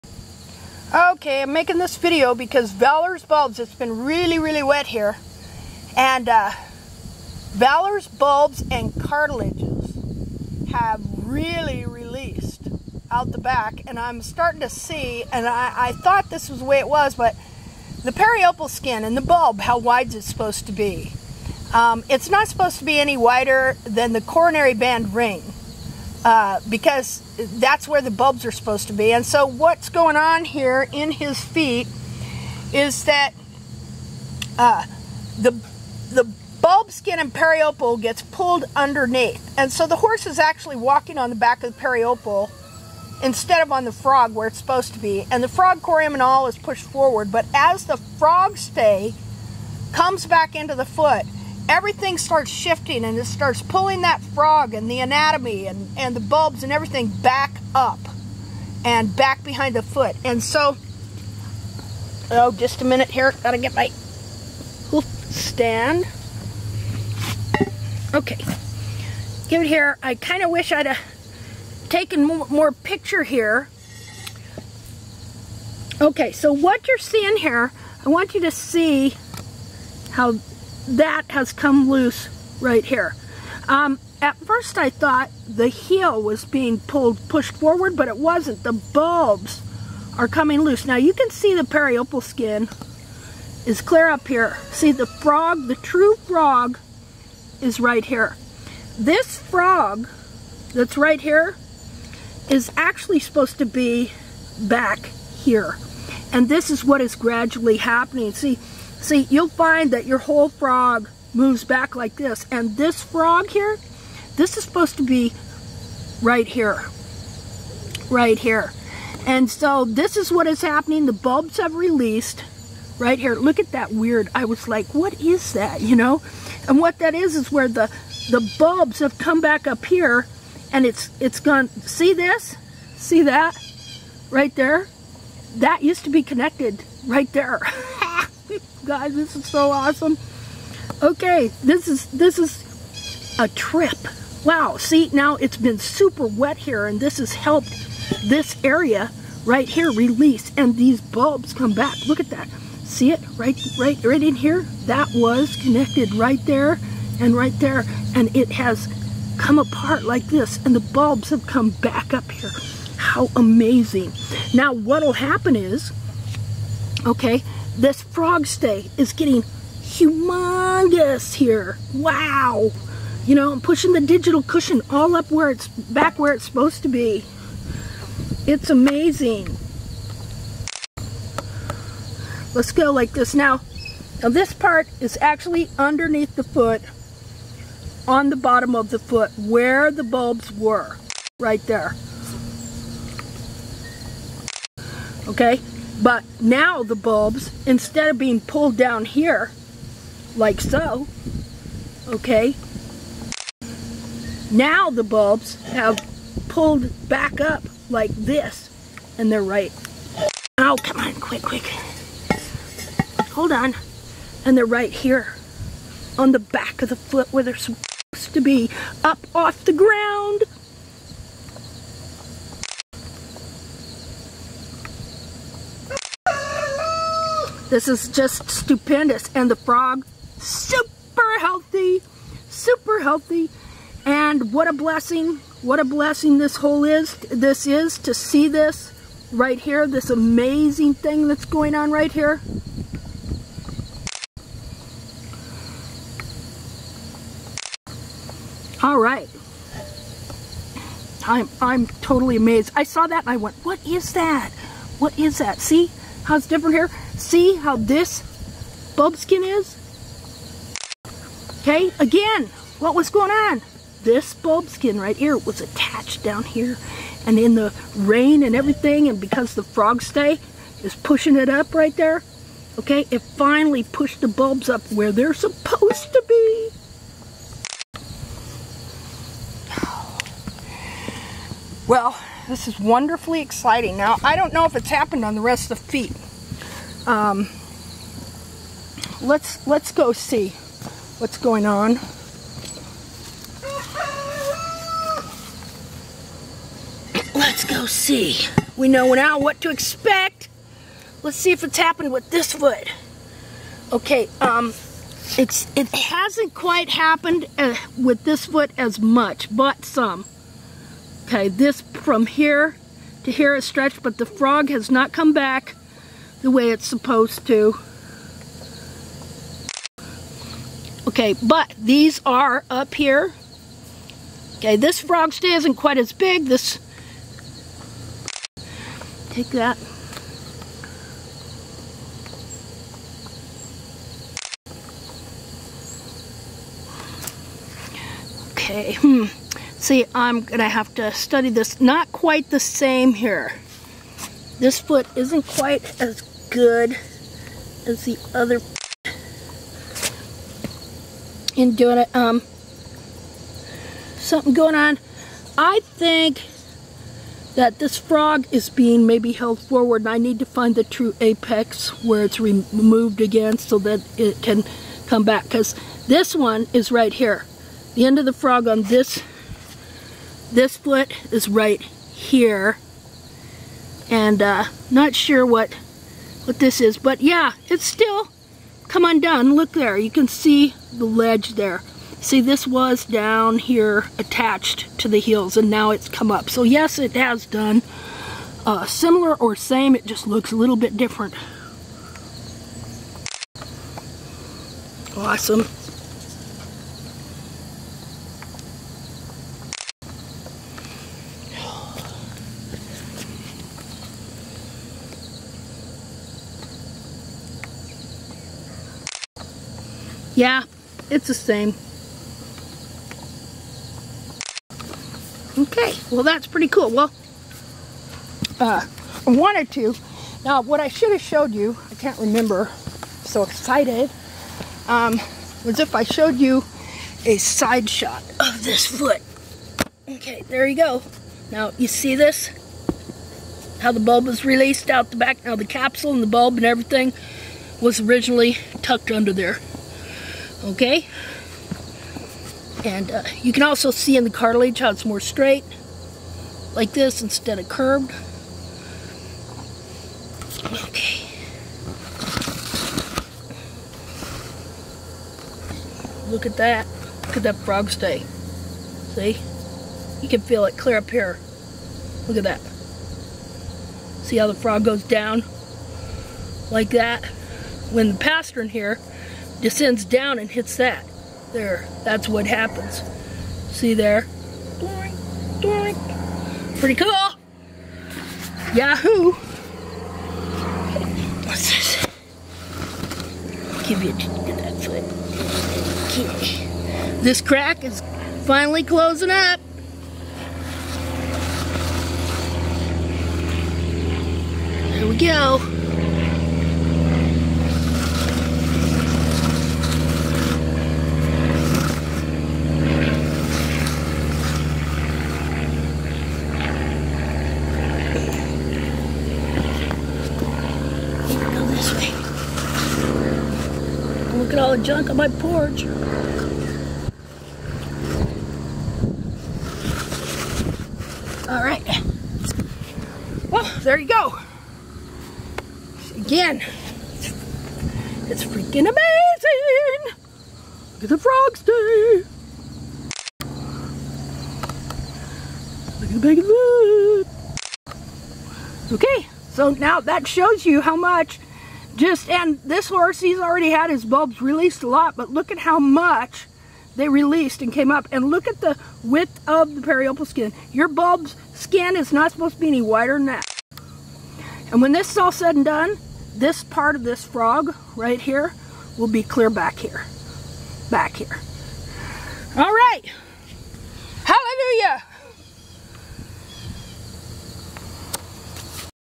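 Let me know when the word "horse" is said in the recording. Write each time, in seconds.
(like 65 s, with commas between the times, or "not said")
39 s, 542 s.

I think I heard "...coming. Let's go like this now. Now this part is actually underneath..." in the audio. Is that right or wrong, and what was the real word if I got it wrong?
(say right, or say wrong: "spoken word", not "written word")
wrong: "amazing", not "coming".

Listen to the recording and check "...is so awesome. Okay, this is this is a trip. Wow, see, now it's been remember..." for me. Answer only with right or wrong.
wrong.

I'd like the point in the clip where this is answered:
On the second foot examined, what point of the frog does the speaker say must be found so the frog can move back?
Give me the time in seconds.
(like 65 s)
360 s.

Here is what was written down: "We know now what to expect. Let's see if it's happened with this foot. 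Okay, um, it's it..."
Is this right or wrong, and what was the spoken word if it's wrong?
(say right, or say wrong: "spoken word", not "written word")
right.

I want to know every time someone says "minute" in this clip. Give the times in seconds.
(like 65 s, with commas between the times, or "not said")
62 s.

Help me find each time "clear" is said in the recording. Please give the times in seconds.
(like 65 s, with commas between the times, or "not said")
93 s, 460 s, 559 s.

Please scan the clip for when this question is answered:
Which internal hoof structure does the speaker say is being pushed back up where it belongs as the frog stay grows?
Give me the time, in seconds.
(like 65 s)
174 s.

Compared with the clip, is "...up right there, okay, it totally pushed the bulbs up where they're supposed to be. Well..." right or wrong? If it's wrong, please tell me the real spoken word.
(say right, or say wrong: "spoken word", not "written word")
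wrong: "finally", not "totally".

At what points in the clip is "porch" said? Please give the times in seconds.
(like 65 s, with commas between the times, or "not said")
515 s.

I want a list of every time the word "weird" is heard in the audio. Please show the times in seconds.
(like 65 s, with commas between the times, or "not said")
123 s.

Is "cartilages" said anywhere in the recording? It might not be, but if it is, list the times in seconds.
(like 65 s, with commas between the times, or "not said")
9 s, 444 s.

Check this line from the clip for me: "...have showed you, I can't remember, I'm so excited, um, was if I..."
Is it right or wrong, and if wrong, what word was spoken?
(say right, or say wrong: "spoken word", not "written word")
right.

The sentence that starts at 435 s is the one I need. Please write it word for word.
Now, the capsule and the bulb and everything was originally tucked under there okay?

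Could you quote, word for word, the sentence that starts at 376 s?
But yeah, it's still come undone.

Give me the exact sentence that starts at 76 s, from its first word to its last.
Okay, so what you're seeing here, I want you to see how that has come loose right here.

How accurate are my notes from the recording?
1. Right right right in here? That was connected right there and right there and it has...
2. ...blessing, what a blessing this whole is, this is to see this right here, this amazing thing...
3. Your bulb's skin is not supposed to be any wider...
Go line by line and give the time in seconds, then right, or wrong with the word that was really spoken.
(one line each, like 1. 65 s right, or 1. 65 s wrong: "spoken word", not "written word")
1. 153 s right
2. 234 s right
3. 550 s right.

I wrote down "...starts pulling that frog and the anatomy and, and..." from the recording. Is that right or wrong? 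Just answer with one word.
right.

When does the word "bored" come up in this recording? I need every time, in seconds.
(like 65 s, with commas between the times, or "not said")
not said.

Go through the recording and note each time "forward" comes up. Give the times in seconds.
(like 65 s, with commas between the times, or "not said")
46 s, 87 s, 359 s.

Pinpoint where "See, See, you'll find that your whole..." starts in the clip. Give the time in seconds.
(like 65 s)
108 s.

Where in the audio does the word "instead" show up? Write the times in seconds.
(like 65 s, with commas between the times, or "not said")
43 s, 197 s, 447 s.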